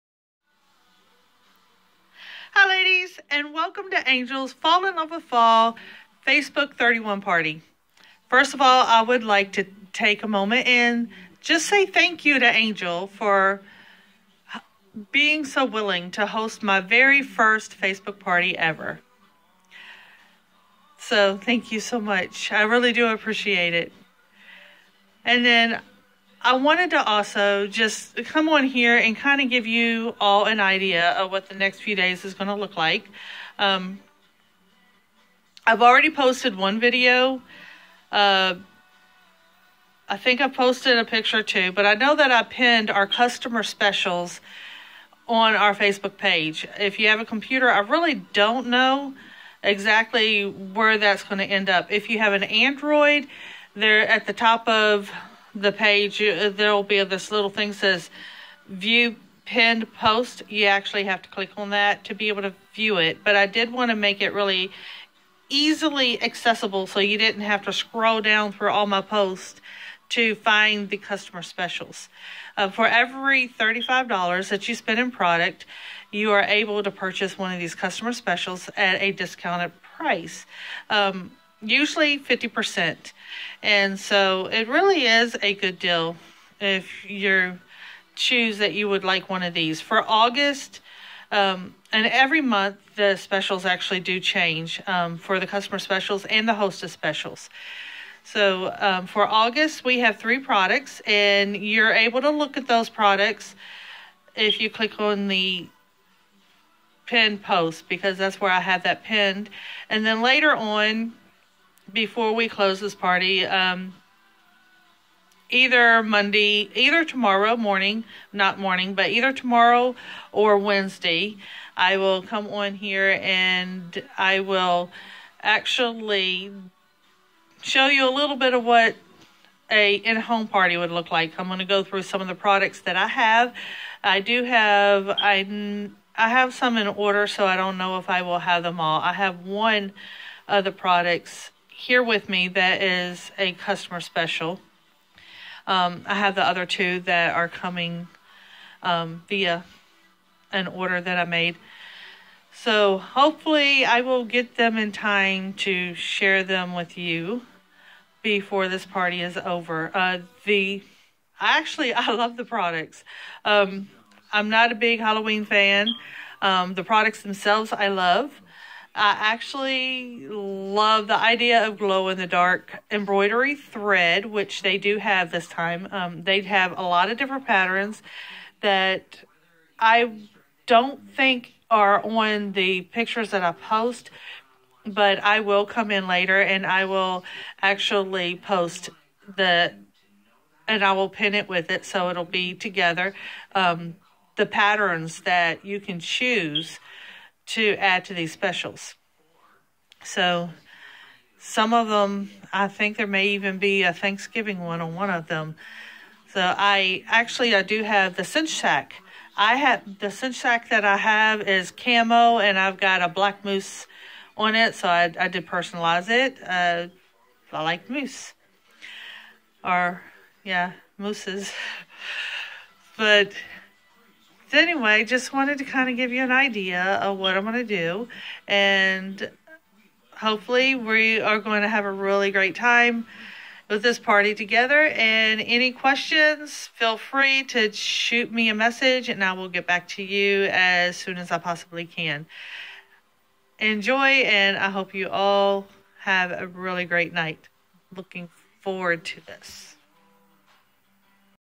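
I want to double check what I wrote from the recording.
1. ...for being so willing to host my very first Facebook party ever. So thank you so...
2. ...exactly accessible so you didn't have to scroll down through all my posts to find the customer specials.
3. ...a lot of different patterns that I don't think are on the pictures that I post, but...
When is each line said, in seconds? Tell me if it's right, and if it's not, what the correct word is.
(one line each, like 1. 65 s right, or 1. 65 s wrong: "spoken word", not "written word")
1. 13 s right
2. 65 s wrong: "easily", not "exactly"
3. 176 s right.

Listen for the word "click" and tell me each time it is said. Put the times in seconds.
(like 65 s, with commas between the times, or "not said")
61 s, 104 s.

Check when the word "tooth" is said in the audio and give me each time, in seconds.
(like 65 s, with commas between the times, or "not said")
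not said.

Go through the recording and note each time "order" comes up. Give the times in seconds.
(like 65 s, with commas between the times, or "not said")
136 s, 150 s.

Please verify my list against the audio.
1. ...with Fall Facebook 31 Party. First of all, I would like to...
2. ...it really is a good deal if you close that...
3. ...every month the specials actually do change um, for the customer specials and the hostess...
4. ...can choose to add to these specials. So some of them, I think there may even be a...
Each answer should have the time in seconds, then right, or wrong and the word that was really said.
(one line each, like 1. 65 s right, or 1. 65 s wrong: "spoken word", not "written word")
1. 5 s right
2. 84 s wrong: "choose", not "close"
3. 92 s right
4. 195 s right.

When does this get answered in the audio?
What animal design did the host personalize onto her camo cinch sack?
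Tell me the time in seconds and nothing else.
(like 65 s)
213 s.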